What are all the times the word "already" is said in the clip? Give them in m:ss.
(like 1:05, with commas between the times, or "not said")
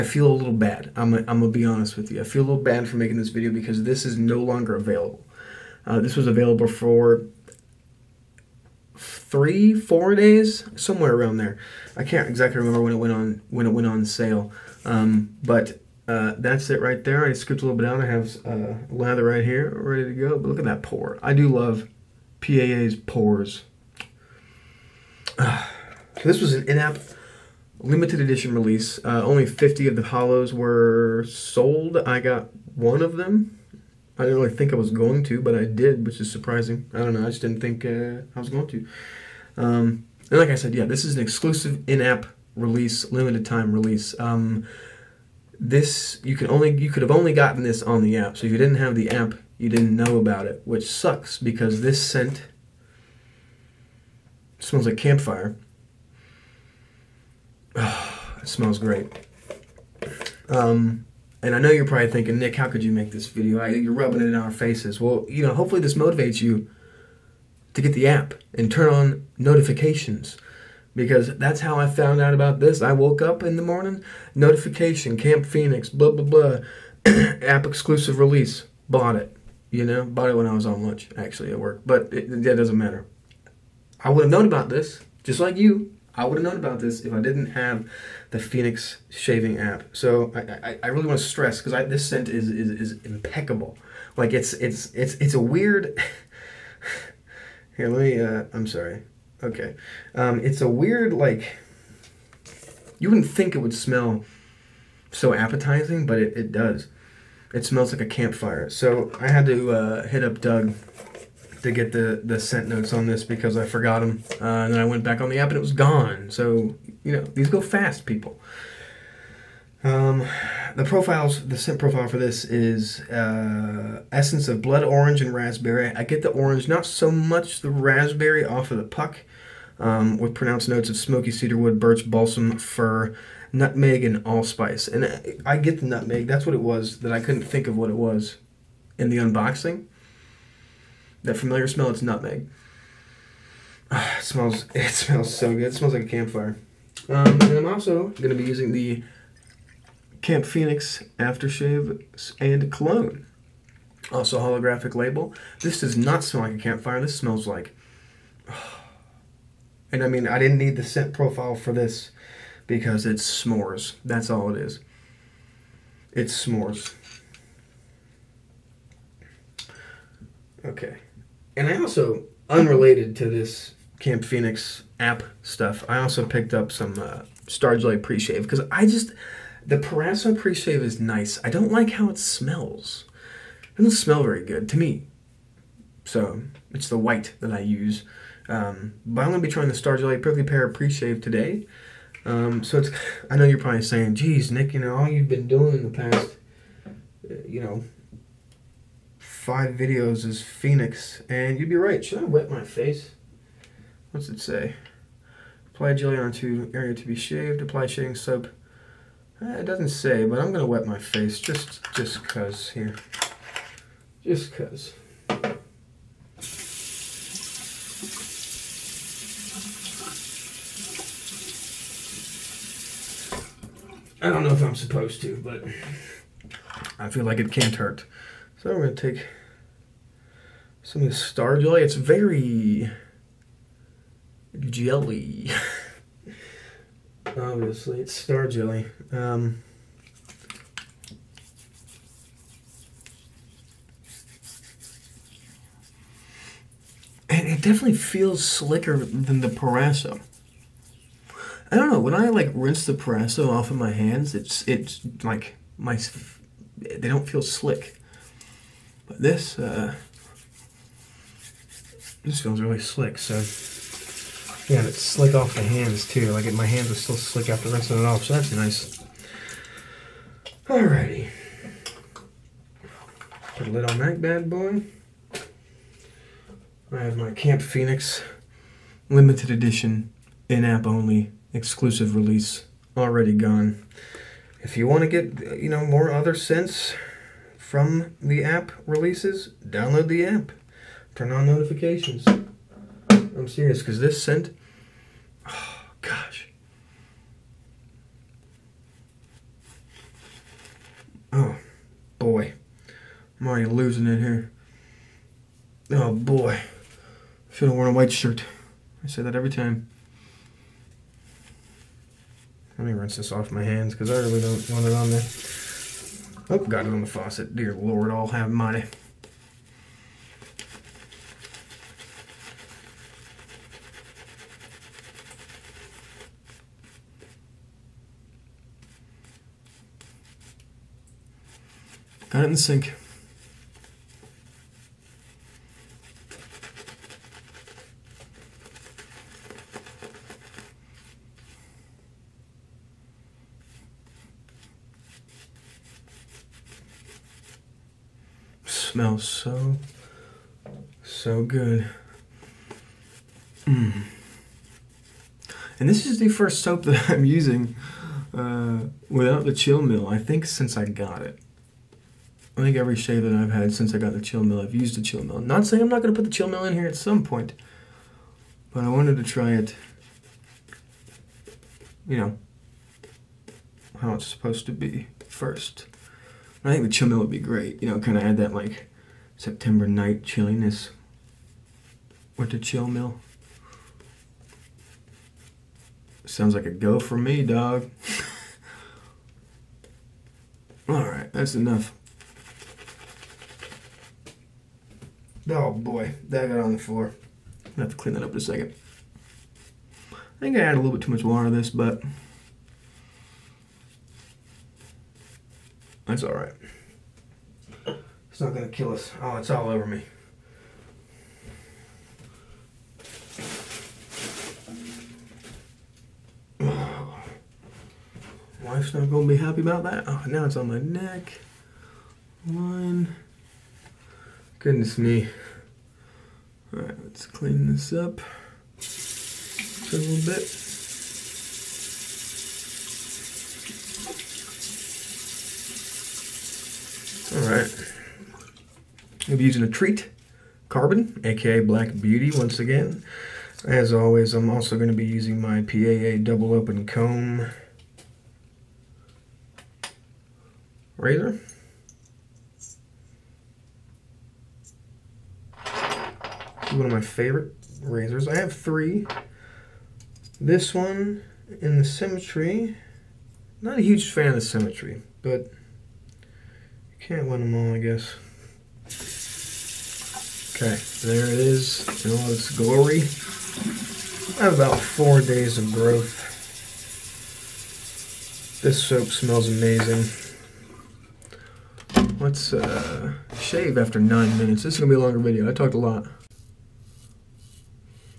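4:42, 5:03.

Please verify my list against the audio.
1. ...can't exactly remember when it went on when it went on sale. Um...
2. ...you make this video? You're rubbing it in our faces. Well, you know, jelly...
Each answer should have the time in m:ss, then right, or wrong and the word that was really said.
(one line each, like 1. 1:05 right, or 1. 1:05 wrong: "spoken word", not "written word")
1. 0:12 right
2. 1:02 wrong: "hopefully", not "jelly".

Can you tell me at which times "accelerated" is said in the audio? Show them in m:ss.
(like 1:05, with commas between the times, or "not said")
not said.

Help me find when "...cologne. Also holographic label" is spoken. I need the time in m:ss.
2:32.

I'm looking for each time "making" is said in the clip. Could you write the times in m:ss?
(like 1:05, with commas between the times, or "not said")
0:02.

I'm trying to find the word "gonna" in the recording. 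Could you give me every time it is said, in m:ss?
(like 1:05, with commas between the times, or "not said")
3:09, 3:30, 3:48, 6:37, 6:48, 6:59.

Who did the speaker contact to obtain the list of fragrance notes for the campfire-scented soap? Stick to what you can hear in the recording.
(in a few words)
Doug.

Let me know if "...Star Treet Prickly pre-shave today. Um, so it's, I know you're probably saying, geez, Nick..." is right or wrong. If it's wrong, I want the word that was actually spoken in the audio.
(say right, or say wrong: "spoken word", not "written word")
wrong: "Jelly", not "Treet".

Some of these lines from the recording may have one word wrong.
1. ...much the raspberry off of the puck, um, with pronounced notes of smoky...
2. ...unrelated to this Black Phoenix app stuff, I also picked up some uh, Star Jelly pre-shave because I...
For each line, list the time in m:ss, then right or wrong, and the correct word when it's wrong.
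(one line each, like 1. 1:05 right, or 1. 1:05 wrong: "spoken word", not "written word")
1. 2:07 right
2. 2:52 wrong: "Camp", not "Black".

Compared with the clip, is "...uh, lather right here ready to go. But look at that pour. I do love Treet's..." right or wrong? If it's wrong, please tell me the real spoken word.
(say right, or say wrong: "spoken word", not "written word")
wrong: "PAA", not "Treet".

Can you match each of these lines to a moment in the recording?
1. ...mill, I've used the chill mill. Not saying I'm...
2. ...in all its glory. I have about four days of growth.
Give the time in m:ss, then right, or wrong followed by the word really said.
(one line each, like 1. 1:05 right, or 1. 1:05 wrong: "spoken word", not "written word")
1. 6:04 right
2. 7:52 right.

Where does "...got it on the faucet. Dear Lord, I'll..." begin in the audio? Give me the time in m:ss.
5:16.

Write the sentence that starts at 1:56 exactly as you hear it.
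So, you know, these go fast, people.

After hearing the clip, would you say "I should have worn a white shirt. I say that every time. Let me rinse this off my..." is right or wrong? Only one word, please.
right.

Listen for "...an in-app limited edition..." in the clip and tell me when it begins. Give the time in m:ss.
0:26.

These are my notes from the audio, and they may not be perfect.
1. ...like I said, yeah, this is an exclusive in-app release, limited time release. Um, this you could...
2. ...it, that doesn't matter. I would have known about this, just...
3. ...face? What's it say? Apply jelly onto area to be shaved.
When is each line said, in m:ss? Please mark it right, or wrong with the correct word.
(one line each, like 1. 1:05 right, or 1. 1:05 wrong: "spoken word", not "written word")
1. 0:40 right
2. 1:22 right
3. 3:22 right.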